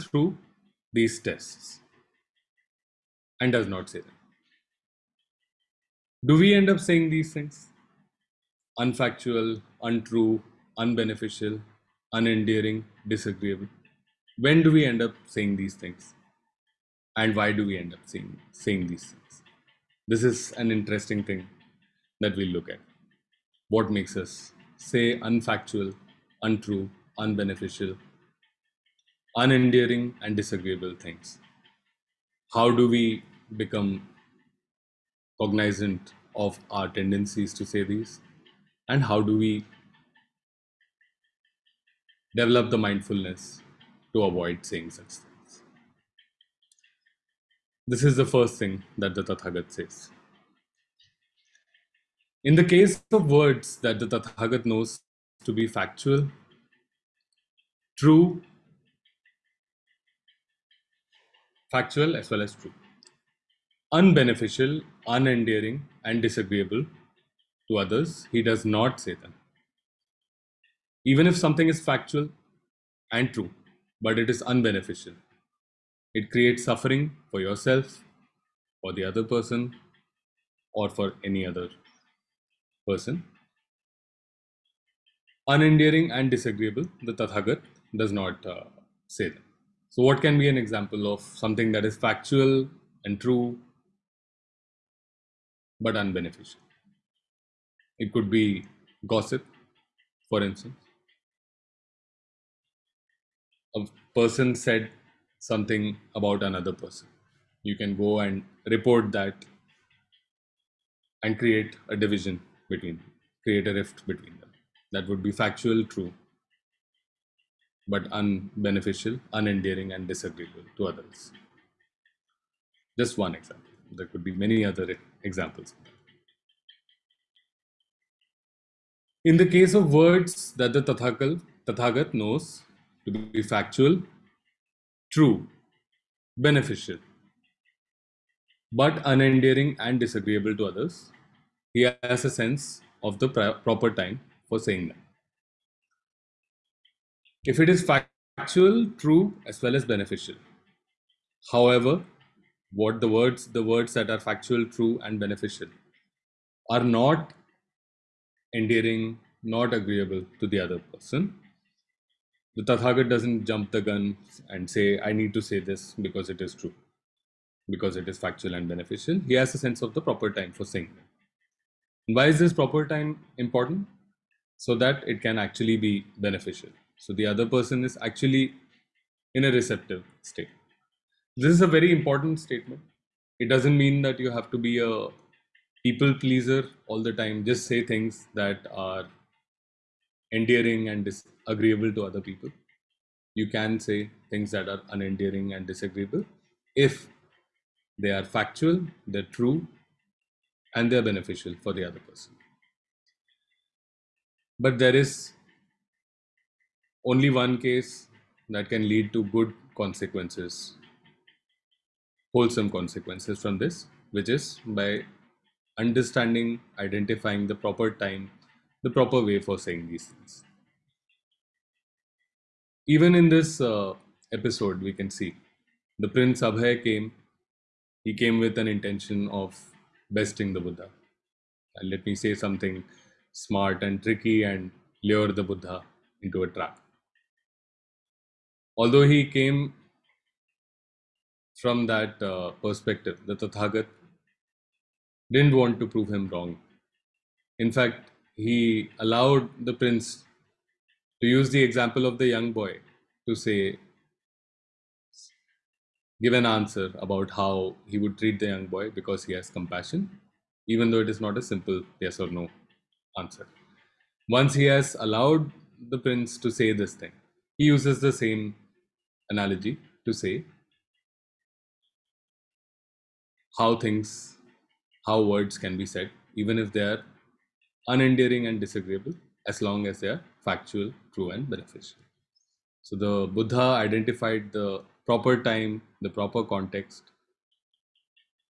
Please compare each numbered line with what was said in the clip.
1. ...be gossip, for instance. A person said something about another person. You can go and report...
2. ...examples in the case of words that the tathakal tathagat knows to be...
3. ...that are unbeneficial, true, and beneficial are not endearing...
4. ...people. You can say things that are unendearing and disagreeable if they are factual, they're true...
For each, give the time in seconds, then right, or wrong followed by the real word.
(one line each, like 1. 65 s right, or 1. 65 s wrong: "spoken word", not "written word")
1. 98 s right
2. 125 s right
3. 153 s wrong: "factual", not "unbeneficial"
4. 192 s right.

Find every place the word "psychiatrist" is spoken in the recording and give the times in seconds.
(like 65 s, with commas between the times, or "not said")
not said.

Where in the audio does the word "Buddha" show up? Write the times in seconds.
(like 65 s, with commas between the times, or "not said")
230 s, 235 s, 283 s.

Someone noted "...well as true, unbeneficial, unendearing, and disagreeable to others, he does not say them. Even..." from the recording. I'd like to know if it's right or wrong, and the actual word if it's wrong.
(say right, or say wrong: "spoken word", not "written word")
right.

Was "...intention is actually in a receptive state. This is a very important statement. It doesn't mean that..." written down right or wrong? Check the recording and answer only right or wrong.
wrong.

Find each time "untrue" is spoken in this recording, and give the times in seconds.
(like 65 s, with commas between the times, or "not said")
9 s, 26 s.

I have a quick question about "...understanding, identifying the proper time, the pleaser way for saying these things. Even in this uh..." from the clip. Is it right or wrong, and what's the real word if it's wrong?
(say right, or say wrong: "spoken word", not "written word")
wrong: "proper", not "pleaser".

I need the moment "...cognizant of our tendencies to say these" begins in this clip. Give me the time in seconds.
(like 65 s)
35 s.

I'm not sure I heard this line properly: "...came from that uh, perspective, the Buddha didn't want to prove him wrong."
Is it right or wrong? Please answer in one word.
wrong.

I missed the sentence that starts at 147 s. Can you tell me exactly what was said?
If it is factual, true, as well as beneficial.